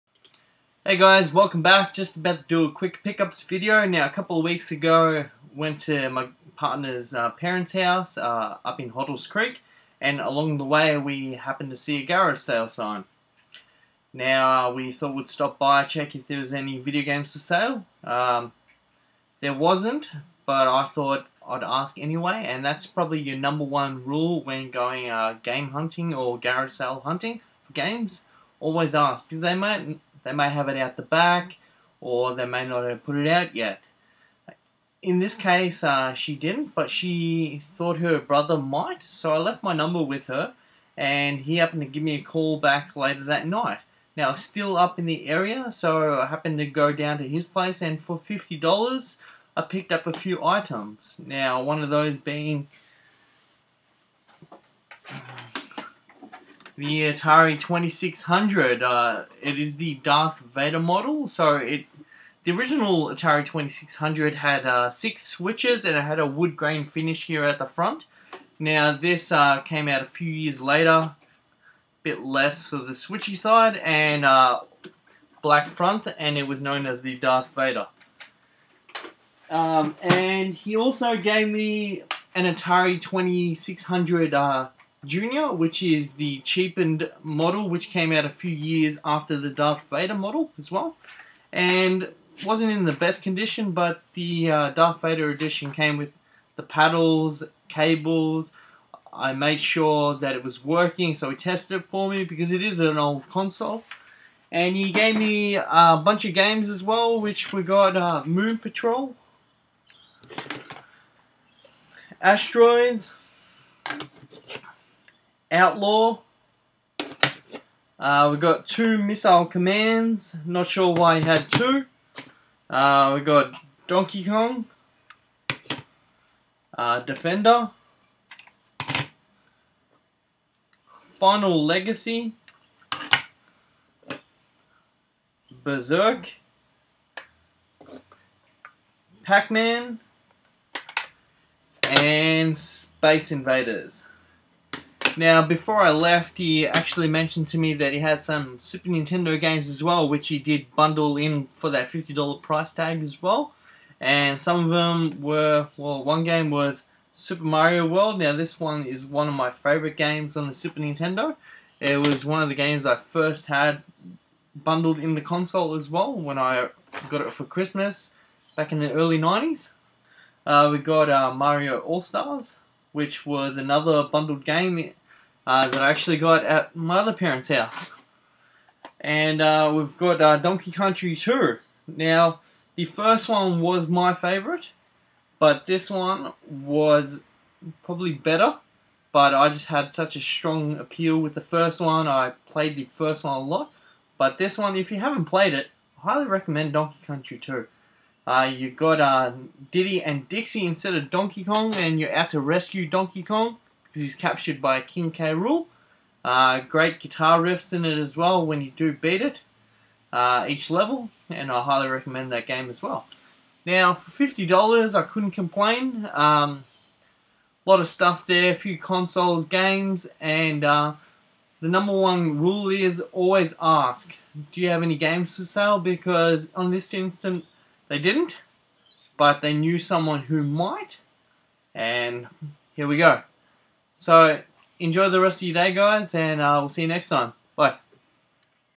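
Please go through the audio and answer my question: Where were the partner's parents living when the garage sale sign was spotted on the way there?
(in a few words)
Hoddles Creek.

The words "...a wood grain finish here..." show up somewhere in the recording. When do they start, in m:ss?
1:06.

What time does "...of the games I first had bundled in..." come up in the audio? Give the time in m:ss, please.
2:42.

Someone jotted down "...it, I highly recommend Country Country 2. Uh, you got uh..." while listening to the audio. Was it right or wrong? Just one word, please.
wrong.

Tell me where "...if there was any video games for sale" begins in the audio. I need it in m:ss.
0:16.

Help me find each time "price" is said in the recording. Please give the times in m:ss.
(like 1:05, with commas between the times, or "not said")
2:32.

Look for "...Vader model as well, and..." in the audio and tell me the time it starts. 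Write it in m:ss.
1:29.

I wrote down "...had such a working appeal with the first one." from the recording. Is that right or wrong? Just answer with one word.
wrong.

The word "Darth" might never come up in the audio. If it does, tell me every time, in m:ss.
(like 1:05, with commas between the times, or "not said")
0:59, 1:17, 1:29, 1:34.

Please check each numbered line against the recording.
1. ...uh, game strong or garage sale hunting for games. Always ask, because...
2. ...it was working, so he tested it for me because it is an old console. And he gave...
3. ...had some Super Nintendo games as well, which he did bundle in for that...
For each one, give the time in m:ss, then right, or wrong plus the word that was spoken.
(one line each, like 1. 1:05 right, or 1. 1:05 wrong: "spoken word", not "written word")
1. 0:25 wrong: "hunting", not "strong"
2. 1:40 right
3. 2:27 right.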